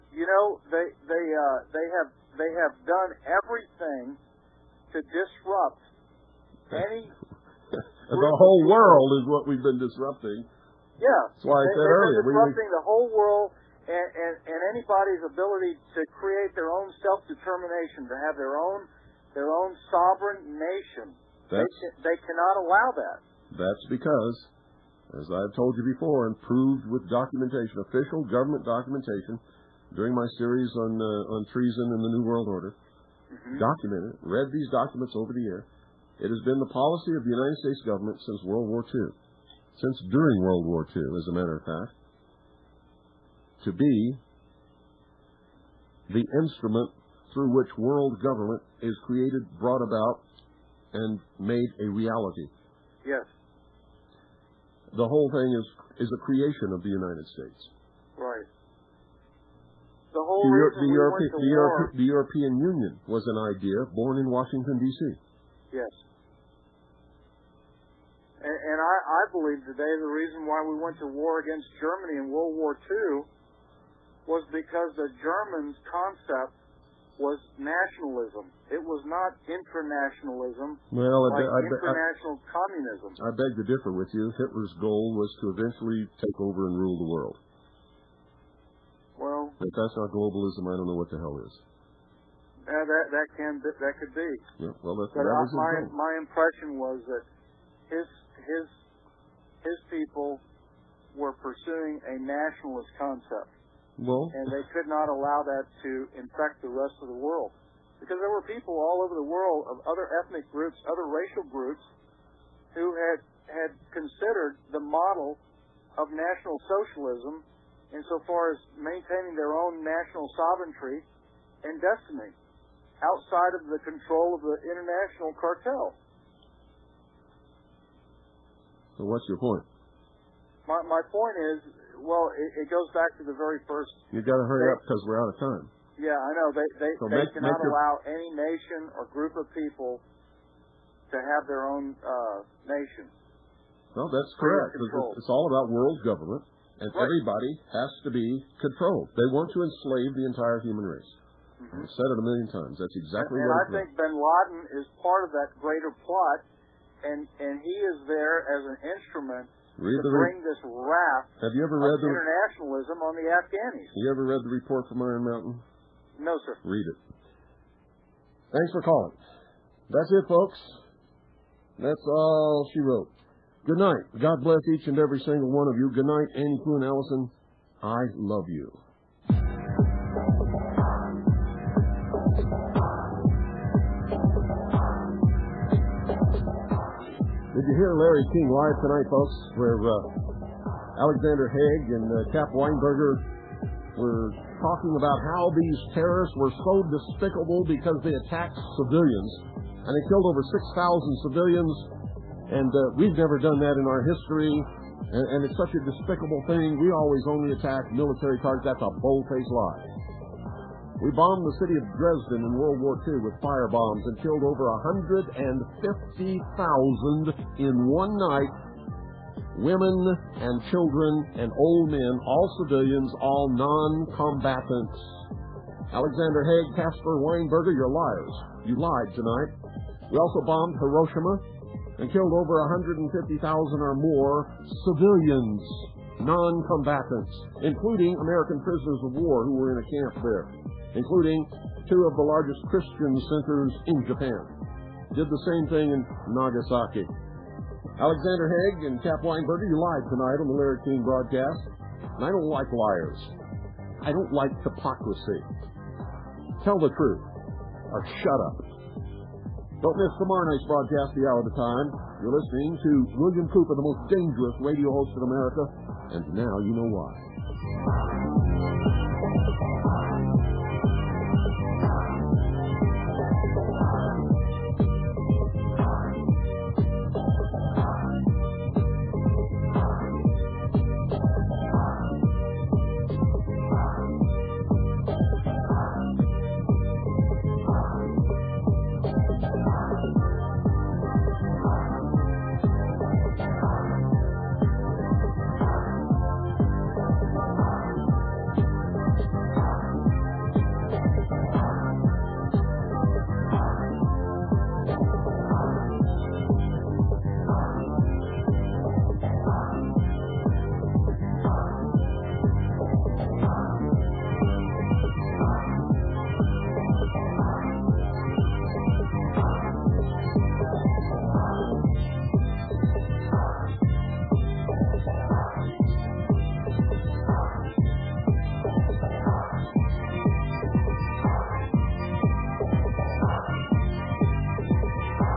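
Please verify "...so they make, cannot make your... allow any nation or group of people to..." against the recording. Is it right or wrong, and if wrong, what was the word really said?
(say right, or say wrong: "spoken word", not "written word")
right.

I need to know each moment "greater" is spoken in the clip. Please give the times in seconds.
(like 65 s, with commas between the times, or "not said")
155 s.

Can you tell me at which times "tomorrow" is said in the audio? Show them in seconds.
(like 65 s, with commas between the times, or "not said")
260 s.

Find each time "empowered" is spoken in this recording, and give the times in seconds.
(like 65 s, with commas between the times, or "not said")
not said.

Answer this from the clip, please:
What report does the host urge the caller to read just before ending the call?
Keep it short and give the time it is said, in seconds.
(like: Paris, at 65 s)
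The Report from Iron Mountain, at 164 s.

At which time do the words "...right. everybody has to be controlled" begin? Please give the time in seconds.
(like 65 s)
146 s.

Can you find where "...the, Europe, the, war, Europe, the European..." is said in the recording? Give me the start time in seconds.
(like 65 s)
60 s.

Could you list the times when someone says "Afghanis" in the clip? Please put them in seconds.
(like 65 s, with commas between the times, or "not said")
163 s.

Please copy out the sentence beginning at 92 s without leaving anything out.
Yeah, that that can that could be.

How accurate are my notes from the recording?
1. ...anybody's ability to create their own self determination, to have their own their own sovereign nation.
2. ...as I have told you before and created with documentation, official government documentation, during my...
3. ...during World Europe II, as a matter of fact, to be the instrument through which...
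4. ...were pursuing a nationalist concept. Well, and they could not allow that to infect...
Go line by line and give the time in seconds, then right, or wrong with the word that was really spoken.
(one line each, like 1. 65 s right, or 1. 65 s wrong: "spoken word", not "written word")
1. 14 s right
2. 25 s wrong: "proved", not "created"
3. 40 s wrong: "War", not "Europe"
4. 101 s right.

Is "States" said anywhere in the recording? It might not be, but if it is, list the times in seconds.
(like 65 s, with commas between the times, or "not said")
37 s, 57 s.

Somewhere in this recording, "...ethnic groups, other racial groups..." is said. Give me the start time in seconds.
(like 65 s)
110 s.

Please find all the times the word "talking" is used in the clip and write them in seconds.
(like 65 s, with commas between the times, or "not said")
194 s.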